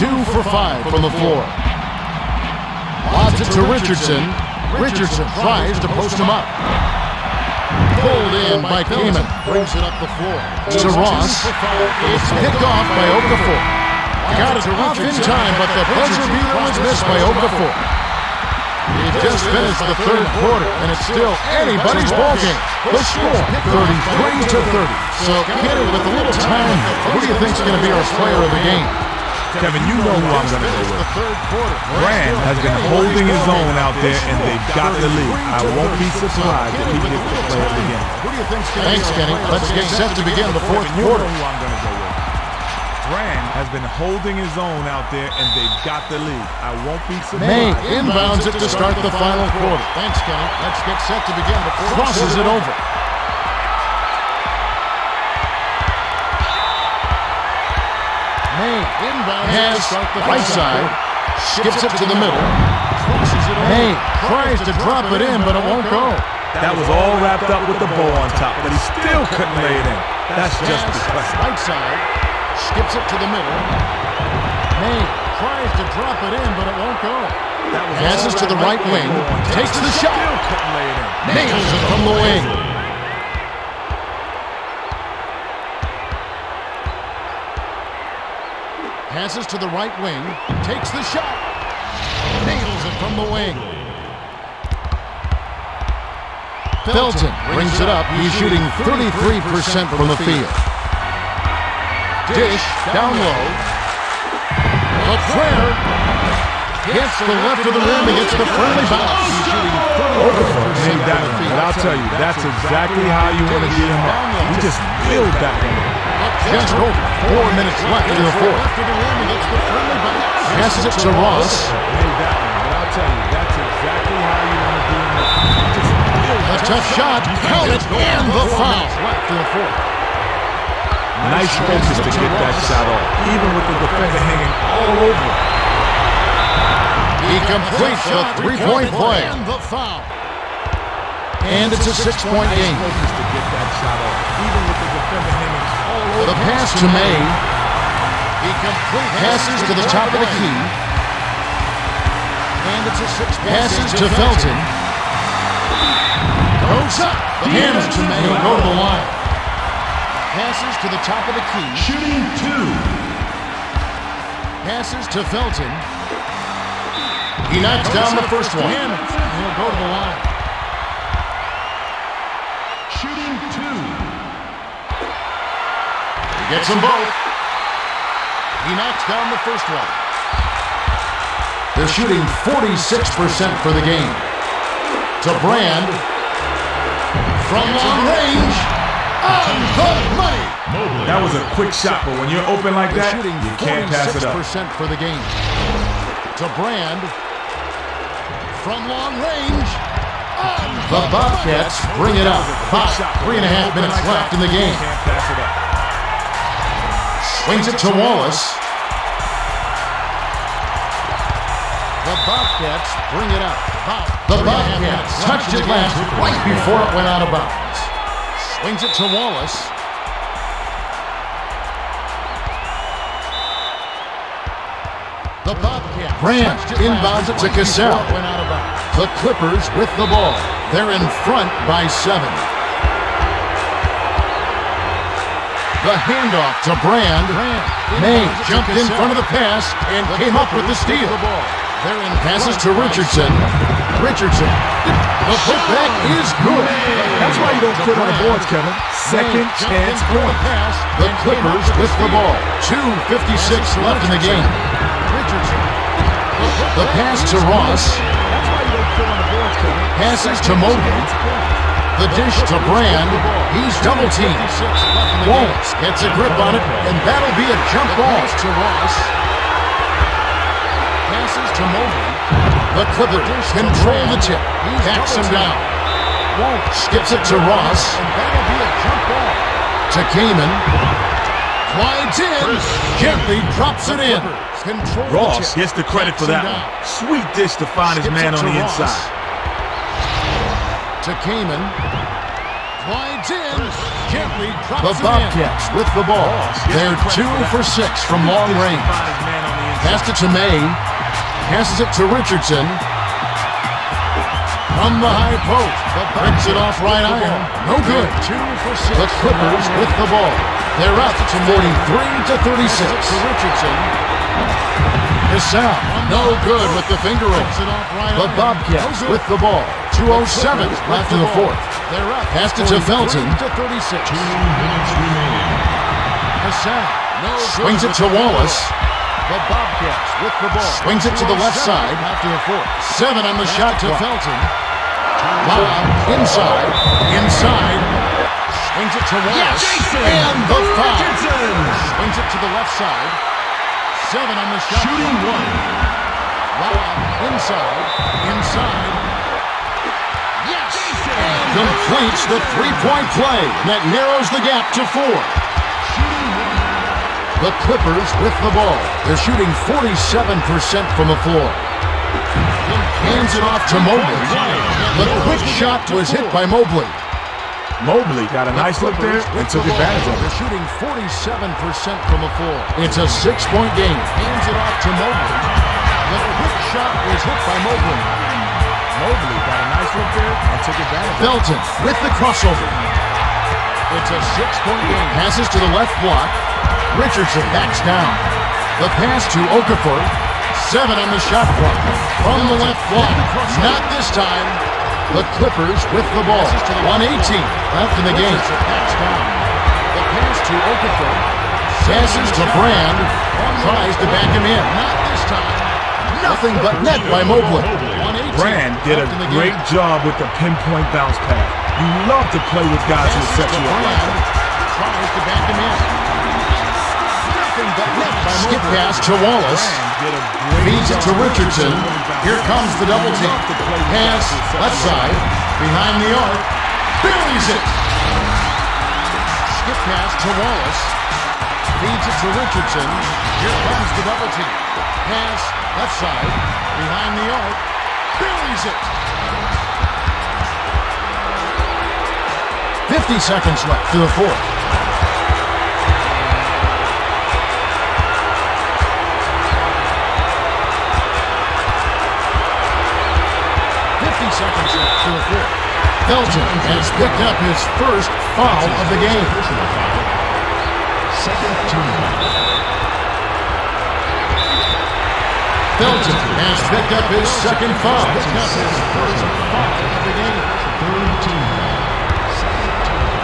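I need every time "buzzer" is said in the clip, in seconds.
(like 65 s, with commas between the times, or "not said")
15 s.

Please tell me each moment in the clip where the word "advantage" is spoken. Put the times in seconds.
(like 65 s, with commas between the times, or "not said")
369 s, 380 s.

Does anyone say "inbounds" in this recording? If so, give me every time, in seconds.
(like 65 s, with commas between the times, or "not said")
47 s, 58 s, 226 s.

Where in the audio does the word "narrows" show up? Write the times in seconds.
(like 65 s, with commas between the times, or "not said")
353 s.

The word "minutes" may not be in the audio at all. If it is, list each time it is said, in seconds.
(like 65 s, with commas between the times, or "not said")
117 s, 203 s.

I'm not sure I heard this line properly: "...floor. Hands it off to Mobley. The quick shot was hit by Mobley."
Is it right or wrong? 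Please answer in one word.
right.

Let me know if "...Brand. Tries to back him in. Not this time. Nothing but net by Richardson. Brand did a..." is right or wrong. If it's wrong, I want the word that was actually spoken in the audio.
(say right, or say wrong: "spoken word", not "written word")
wrong: "Mobley", not "Richardson".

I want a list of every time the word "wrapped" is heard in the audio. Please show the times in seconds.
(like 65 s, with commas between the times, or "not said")
67 s.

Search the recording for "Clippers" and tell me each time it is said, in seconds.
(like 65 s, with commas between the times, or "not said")
229 s, 251 s, 272 s, 309 s, 357 s, 395 s.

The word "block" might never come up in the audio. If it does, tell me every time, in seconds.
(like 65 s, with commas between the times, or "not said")
386 s, 392 s.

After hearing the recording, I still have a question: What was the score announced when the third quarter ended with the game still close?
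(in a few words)
33 to 30.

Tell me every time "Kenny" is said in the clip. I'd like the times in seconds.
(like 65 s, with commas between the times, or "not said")
25 s, 39 s, 50 s.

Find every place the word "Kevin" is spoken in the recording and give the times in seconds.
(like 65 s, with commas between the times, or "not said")
29 s, 248 s.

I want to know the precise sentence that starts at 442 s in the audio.
50 seconds left to the fourth.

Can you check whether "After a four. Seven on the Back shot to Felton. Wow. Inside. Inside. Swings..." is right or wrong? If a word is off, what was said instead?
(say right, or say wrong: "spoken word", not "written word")
right.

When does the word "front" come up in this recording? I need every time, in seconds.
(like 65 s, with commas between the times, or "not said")
231 s, 238 s.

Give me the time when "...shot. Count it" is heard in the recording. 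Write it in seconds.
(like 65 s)
126 s.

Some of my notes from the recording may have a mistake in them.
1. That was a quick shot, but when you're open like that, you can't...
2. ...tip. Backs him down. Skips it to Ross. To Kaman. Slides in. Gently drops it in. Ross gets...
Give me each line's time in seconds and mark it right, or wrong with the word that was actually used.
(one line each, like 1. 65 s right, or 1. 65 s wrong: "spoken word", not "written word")
1. 191 s right
2. 274 s right.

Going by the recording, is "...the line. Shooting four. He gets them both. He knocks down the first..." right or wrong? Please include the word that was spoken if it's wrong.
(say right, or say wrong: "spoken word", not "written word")
wrong: "two", not "four".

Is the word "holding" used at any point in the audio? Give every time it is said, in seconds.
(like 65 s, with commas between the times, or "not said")
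32 s, 43 s.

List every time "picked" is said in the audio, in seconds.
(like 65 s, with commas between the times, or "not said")
12 s, 457 s, 466 s.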